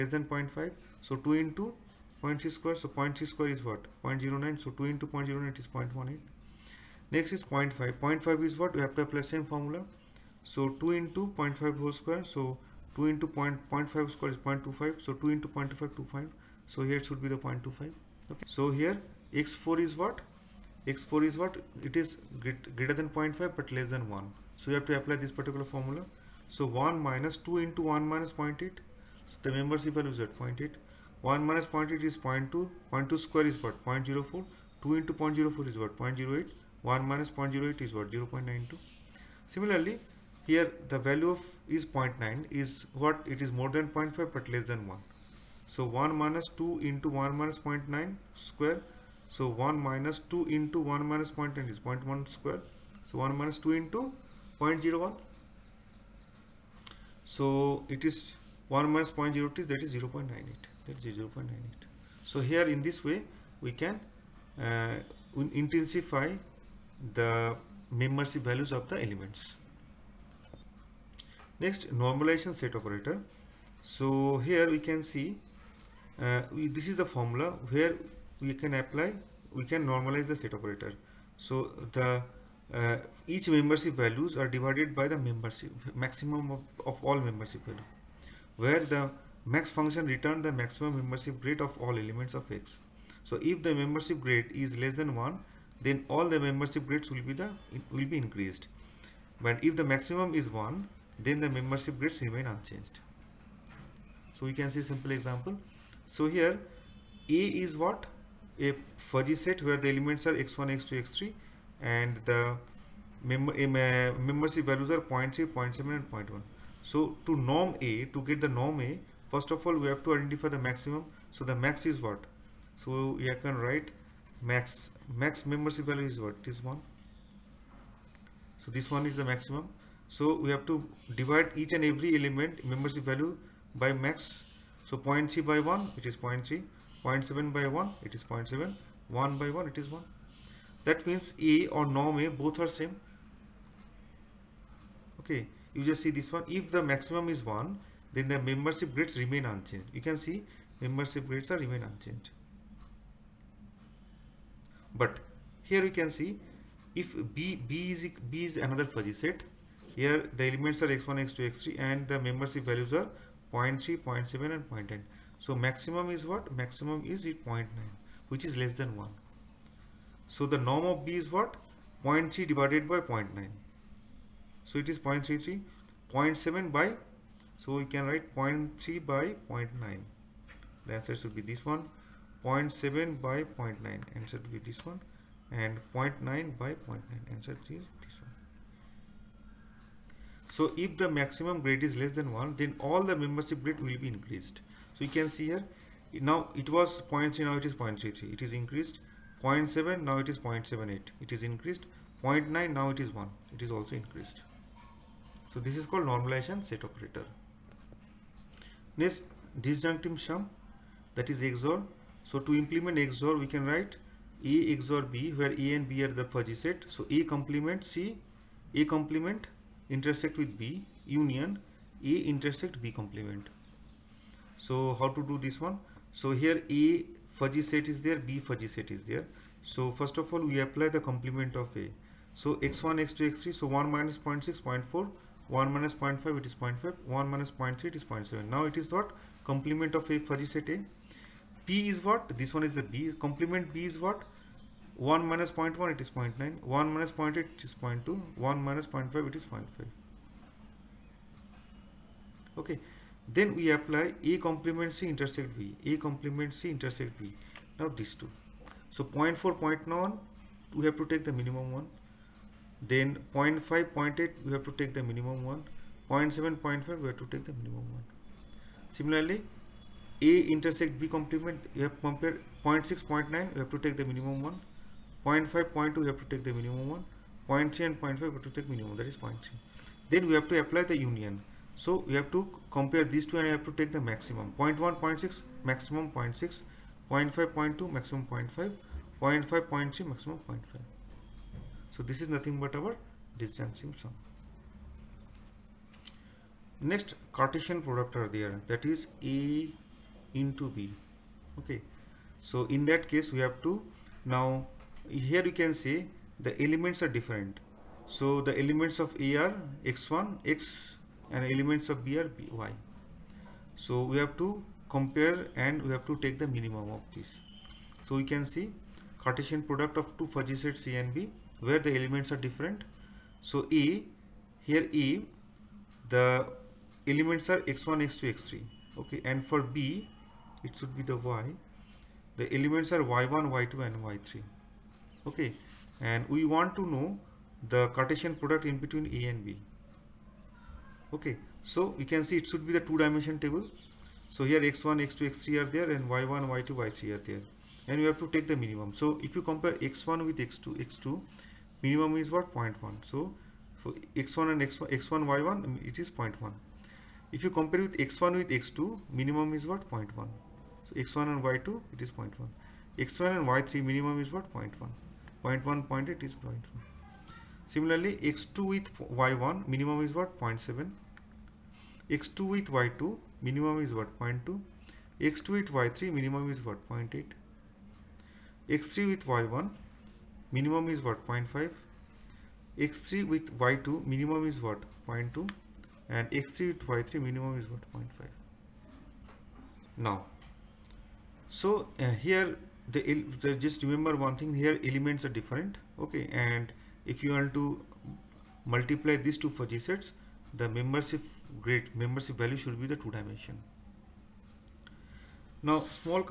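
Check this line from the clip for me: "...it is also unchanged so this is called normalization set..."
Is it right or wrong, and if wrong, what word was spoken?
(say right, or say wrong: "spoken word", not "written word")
wrong: "increased", not "unchanged".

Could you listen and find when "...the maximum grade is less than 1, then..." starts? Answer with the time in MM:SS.
03:10.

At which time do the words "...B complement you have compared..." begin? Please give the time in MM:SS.
04:30.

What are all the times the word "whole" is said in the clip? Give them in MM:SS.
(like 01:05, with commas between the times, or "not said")
00:11.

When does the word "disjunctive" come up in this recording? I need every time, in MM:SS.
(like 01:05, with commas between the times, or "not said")
03:29, 04:53.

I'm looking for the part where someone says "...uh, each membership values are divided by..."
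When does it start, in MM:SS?
01:22.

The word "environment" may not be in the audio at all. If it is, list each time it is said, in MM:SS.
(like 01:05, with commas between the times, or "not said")
not said.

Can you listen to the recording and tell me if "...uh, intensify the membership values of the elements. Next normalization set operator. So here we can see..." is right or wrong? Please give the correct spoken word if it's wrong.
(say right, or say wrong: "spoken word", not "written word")
right.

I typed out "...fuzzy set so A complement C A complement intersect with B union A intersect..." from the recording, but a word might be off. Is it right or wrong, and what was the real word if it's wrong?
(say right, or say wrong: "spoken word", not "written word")
right.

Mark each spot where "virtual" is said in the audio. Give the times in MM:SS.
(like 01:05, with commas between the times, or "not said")
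not said.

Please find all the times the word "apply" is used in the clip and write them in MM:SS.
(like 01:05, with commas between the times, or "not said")
00:09, 00:24, 01:18, 03:50, 04:13, 04:40.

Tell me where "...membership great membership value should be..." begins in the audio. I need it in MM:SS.
06:40.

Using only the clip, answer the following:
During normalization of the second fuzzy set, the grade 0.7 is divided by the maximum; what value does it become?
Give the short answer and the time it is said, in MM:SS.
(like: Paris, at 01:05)
0.78, at 03:20.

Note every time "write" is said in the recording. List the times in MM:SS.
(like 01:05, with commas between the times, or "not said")
02:03, 02:58, 03:33.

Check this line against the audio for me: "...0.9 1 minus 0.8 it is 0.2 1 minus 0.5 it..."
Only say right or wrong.
right.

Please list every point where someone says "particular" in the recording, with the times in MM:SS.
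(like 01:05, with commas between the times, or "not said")
00:25.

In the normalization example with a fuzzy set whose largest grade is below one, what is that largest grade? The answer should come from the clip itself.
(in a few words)
0.9.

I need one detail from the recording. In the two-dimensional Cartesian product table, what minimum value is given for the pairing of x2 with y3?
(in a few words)
0.8.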